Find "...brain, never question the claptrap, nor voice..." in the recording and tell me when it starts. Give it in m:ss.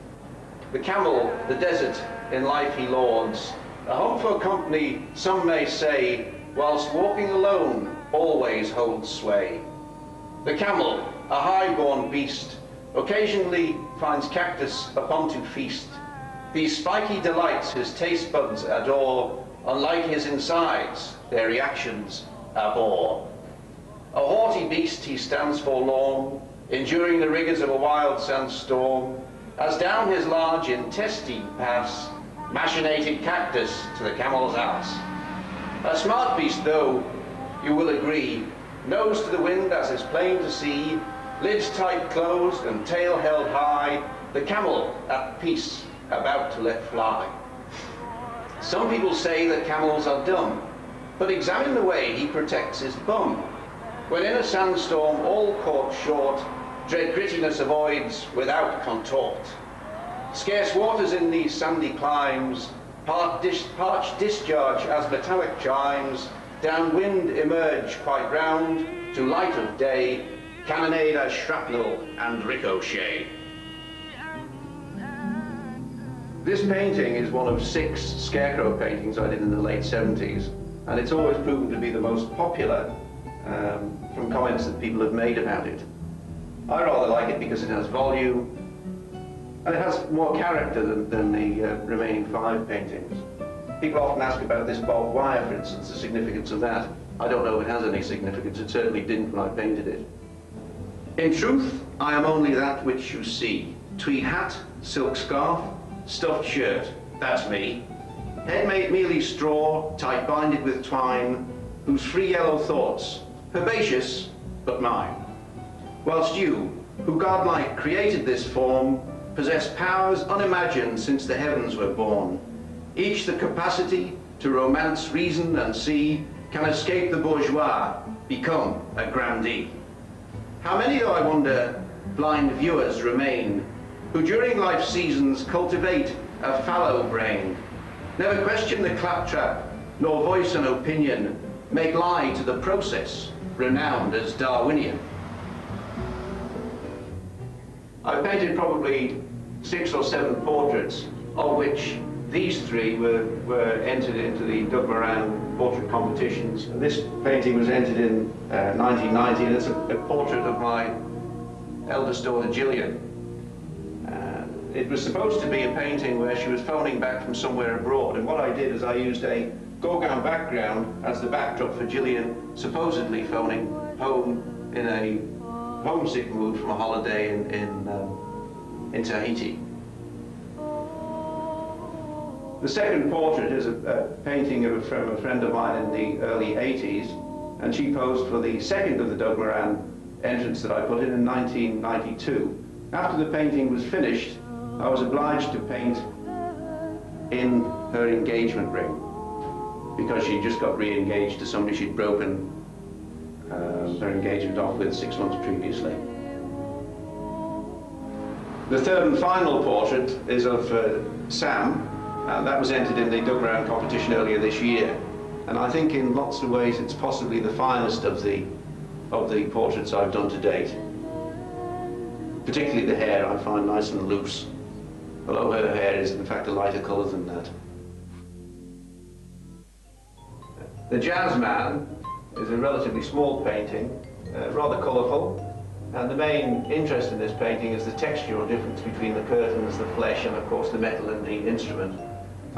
2:17.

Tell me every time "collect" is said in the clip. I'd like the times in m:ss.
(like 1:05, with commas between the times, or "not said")
not said.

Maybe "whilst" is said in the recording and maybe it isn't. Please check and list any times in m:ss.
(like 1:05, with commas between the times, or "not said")
0:06, 1:56.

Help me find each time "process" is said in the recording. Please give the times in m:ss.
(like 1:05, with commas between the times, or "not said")
2:22.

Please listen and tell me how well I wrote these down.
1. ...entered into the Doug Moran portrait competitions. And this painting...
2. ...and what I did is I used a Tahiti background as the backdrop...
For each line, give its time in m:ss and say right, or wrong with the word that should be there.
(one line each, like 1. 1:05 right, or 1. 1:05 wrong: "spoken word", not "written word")
1. 2:33 right
2. 2:48 wrong: "Gauguin", not "Tahiti".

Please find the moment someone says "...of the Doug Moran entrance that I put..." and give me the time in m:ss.
3:08.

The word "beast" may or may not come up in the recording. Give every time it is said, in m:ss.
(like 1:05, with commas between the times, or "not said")
0:12, 0:24, 0:36.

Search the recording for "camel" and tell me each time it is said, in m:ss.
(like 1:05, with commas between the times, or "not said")
0:00, 0:10, 0:34, 0:44, 0:49.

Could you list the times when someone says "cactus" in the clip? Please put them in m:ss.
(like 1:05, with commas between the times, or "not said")
0:14, 0:33.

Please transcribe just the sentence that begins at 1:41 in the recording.
In truth, I am only that which you see.